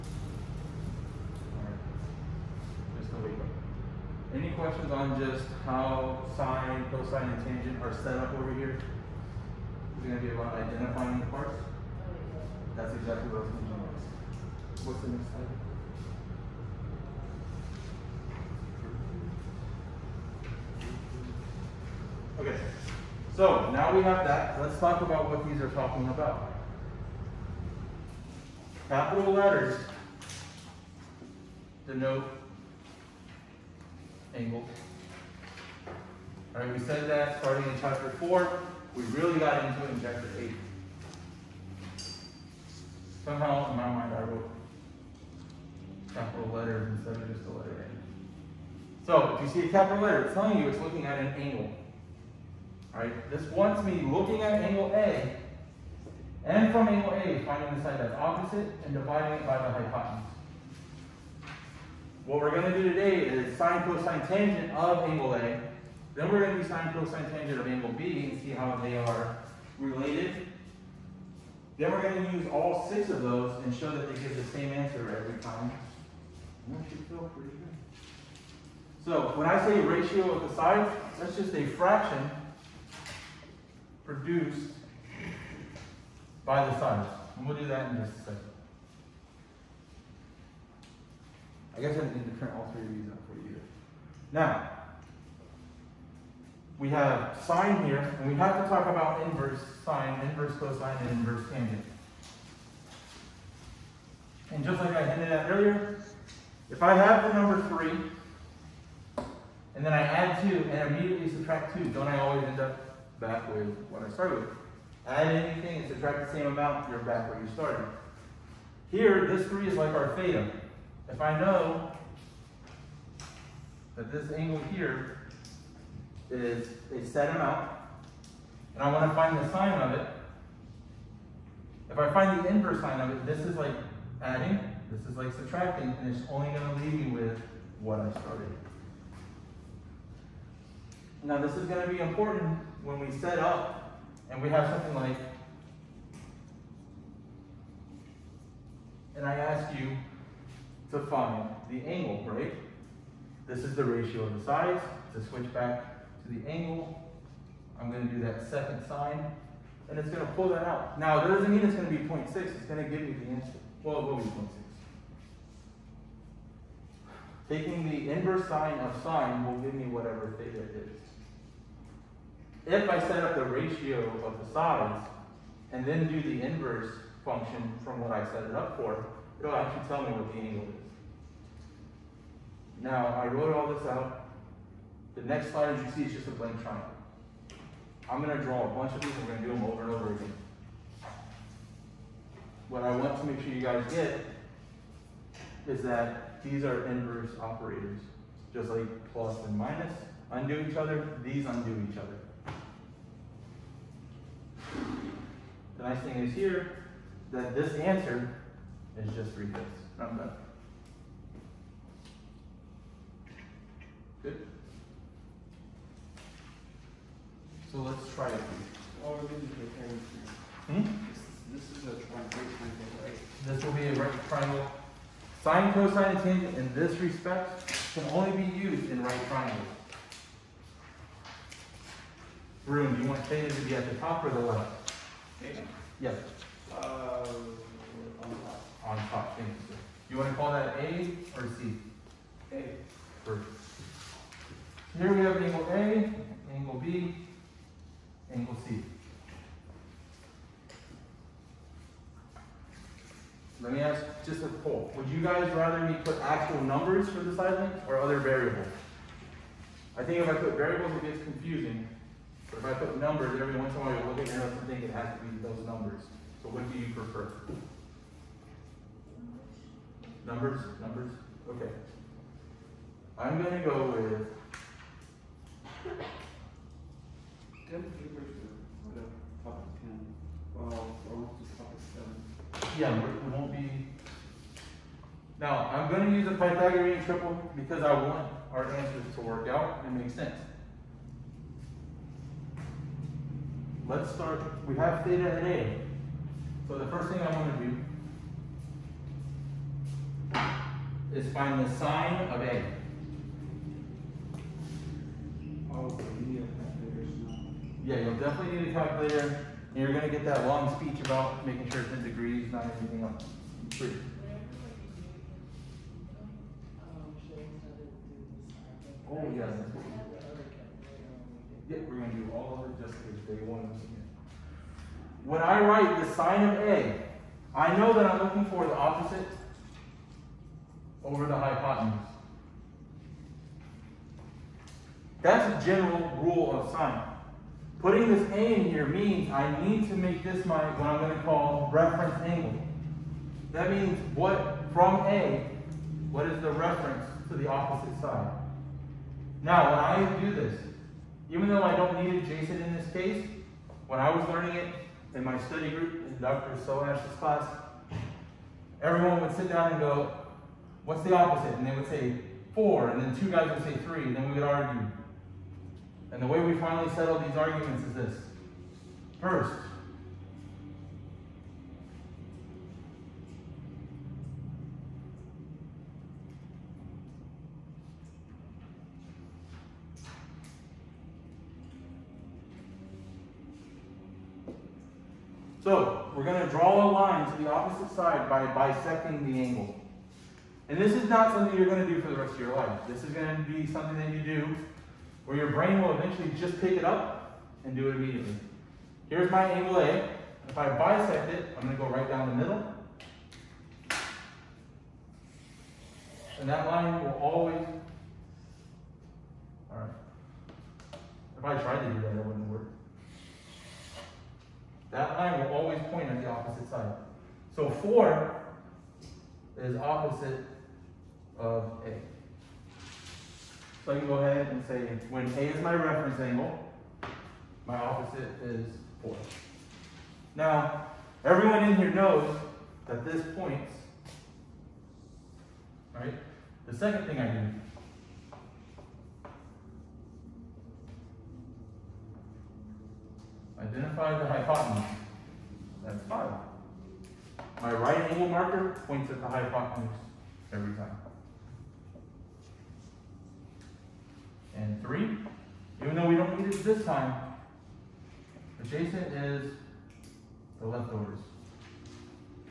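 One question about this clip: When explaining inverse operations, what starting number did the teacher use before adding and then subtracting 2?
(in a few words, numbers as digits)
3.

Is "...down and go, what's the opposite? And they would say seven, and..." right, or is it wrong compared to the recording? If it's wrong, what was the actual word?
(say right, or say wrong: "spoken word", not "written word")
wrong: "four", not "seven".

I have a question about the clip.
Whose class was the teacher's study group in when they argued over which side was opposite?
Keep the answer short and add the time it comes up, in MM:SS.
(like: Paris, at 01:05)
Dr. Soash, at 05:56.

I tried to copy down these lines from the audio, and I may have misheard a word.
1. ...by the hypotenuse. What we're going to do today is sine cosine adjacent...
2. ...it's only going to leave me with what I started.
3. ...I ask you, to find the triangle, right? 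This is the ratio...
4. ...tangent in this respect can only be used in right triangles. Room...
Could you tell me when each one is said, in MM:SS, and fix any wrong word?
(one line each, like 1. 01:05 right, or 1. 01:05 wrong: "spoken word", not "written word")
1. 00:59 wrong: "tangent", not "adjacent"
2. 02:16 right
3. 02:29 wrong: "angle", not "triangle"
4. 03:46 right.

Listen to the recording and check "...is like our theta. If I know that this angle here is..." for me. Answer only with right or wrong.
right.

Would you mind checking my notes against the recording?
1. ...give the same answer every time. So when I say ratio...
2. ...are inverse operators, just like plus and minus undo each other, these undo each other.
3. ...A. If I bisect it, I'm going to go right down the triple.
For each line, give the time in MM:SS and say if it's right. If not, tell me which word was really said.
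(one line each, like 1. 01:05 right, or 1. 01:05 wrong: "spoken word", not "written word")
1. 01:14 right
2. 03:16 right
3. 06:39 wrong: "middle", not "triple".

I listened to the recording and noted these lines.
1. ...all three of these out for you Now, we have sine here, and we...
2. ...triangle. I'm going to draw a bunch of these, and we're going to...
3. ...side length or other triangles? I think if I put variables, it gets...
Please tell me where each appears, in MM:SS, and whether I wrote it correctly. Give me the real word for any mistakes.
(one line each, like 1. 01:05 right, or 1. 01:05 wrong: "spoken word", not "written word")
1. 01:32 right
2. 03:06 right
3. 04:17 wrong: "variables", not "triangles".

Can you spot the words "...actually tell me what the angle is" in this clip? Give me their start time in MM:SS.
02:59.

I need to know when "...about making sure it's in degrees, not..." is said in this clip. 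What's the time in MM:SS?
05:11.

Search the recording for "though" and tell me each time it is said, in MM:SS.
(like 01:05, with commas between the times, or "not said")
05:51, 07:35.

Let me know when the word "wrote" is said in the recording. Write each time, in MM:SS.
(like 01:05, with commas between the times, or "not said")
00:44, 03:03.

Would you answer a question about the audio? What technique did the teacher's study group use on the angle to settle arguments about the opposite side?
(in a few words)
bisecting the angle.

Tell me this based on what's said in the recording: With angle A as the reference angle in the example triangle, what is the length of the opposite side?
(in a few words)
4.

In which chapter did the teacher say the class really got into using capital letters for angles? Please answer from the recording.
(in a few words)
chapter 8.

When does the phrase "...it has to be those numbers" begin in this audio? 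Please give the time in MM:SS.
04:24.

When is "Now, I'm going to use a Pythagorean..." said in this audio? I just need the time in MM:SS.
04:45.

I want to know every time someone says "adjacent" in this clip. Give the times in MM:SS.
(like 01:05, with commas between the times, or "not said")
05:52, 07:38.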